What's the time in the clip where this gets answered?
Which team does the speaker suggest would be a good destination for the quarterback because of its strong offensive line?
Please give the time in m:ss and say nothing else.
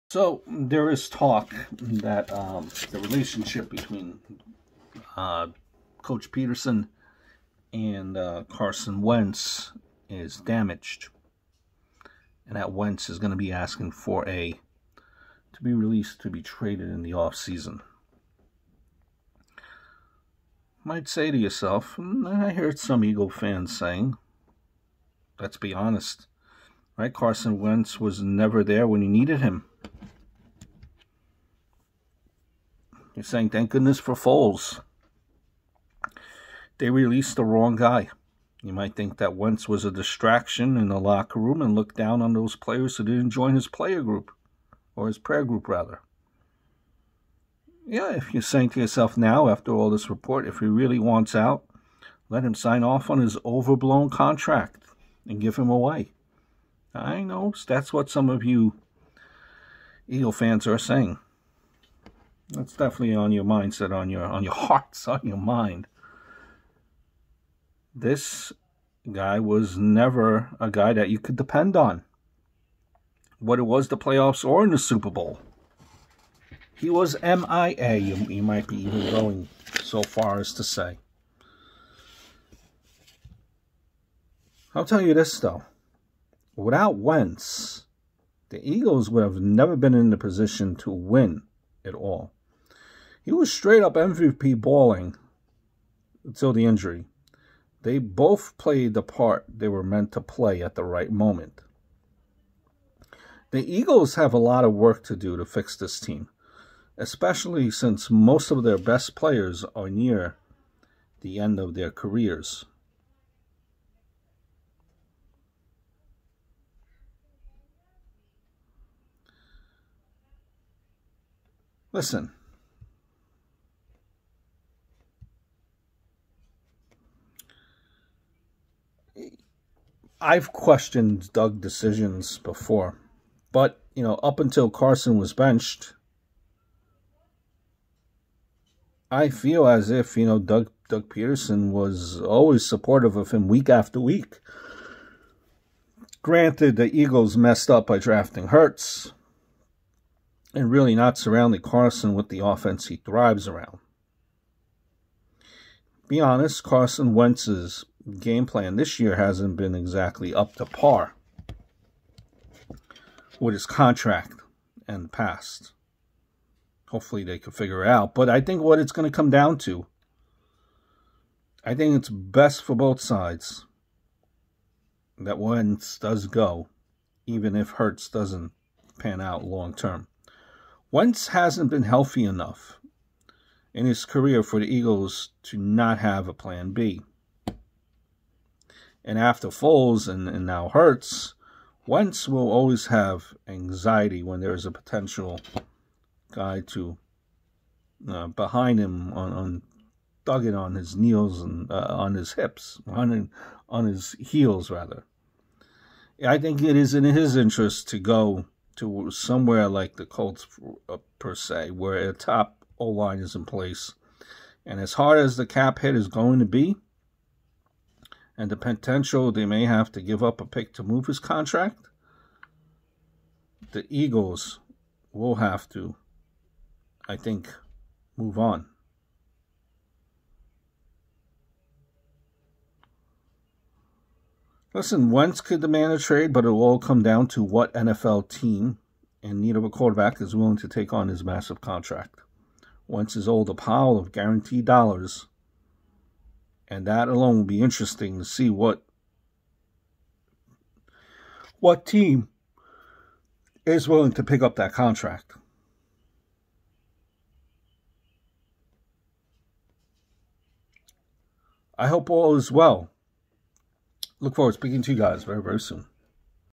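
3:30.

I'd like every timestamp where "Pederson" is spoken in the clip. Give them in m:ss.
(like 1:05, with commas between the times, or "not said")
0:06, 2:21.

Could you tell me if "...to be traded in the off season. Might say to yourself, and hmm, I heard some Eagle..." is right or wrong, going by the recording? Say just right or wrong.
right.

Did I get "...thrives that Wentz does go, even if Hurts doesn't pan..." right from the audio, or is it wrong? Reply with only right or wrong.
wrong.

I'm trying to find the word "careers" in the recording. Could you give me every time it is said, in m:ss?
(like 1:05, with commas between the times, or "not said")
1:51, 3:04.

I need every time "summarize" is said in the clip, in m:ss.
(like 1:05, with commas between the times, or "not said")
not said.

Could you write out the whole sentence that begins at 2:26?
Granted, the Eagles messed up by drafting Hurts and really not surrounding Carson with the offense he thrives around.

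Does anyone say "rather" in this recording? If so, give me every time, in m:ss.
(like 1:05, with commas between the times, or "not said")
0:45, 3:24.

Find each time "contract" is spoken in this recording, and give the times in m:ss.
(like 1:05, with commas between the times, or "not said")
0:54, 2:43, 3:41, 4:01, 4:14.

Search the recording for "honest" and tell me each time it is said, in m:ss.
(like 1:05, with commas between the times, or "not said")
0:25, 2:36.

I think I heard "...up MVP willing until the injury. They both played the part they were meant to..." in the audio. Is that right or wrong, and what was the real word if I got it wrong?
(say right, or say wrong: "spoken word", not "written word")
wrong: "balling", not "willing".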